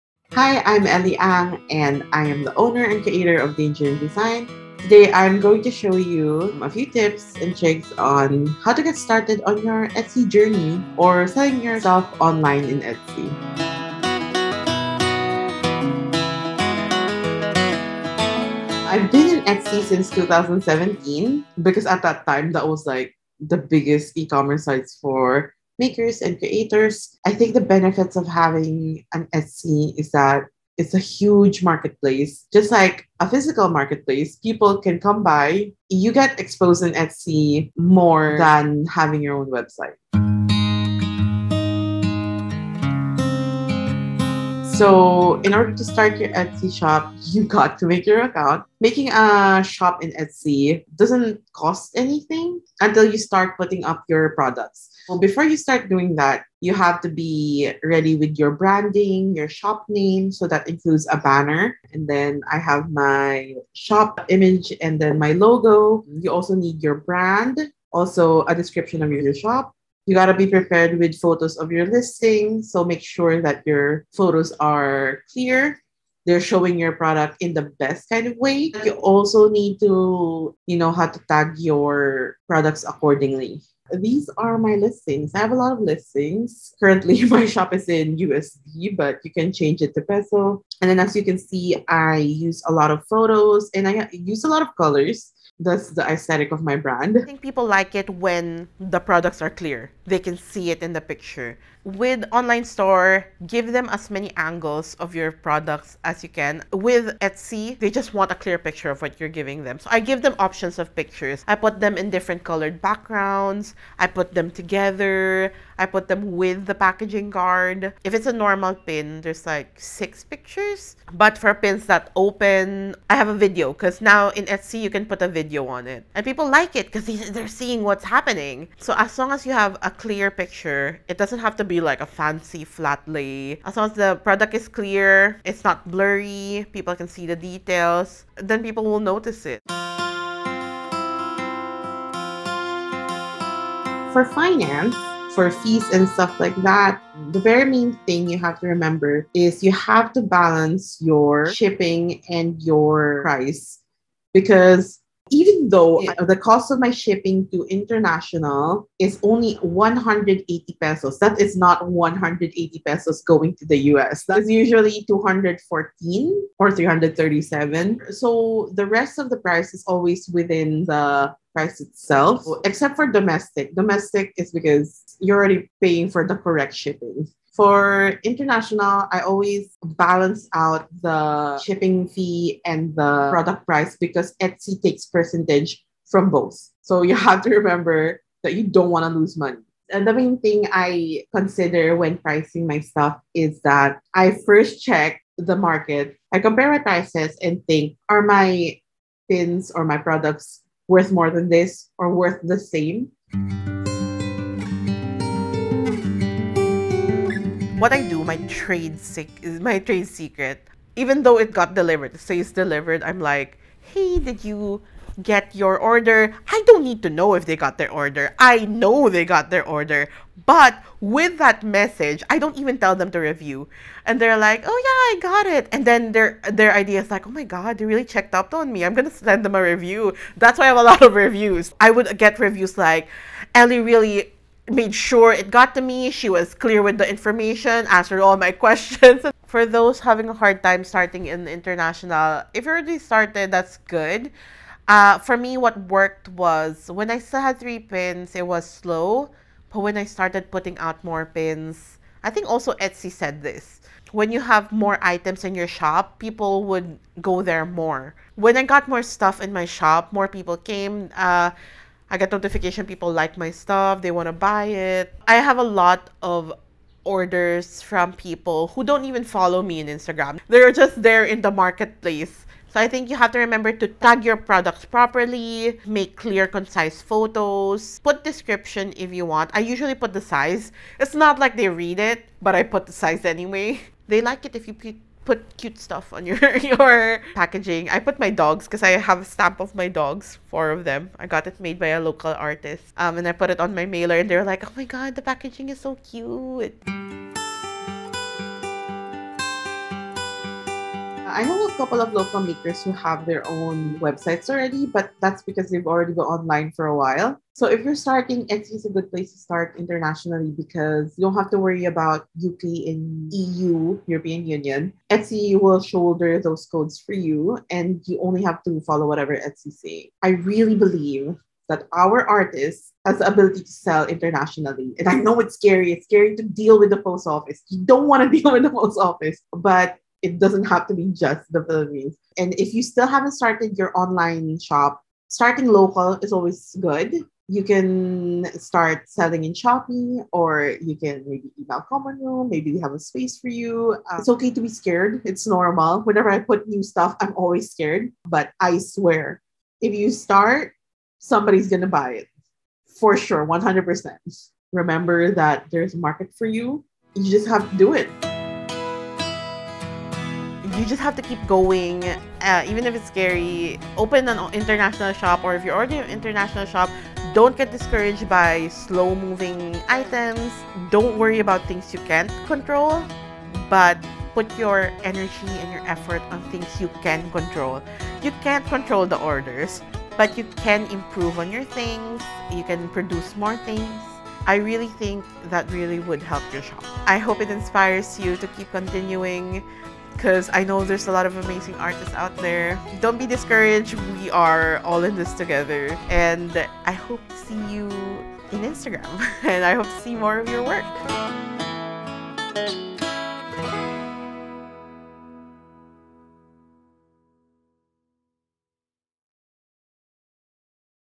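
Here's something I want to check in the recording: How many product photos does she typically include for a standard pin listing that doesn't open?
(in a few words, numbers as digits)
6.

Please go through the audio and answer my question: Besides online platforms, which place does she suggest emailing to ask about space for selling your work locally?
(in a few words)
Common Room.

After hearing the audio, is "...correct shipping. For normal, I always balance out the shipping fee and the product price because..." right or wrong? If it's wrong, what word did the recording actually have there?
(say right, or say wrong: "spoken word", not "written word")
wrong: "international", not "normal".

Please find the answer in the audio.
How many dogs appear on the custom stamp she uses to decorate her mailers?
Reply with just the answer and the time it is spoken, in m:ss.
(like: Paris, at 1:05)
4, at 4:50.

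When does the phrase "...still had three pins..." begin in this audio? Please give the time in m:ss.
4:07.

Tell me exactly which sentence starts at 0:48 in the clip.
Making a shop in Etsy doesn't cost anything until you start putting up your products.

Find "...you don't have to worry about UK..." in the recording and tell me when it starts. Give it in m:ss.
5:11.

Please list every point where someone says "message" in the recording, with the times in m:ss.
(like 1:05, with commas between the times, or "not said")
3:41.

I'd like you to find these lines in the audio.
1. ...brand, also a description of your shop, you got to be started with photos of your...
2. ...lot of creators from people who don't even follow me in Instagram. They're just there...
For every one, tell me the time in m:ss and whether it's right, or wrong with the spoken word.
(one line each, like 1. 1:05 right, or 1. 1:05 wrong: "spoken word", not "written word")
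1. 1:07 wrong: "prepared", not "started"
2. 4:25 wrong: "orders", not "creators".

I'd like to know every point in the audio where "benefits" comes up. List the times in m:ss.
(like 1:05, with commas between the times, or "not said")
0:27.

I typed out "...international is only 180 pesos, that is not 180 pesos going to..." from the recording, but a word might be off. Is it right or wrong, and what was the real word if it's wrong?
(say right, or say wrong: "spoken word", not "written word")
right.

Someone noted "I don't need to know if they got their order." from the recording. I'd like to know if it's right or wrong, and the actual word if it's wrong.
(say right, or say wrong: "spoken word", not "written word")
right.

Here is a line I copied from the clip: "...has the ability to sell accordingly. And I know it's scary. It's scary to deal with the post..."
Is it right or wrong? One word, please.
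wrong.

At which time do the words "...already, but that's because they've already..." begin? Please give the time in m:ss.
5:04.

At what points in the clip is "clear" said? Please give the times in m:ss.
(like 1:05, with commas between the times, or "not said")
1:15, 1:39, 1:48, 2:09, 2:14, 3:56, 4:36.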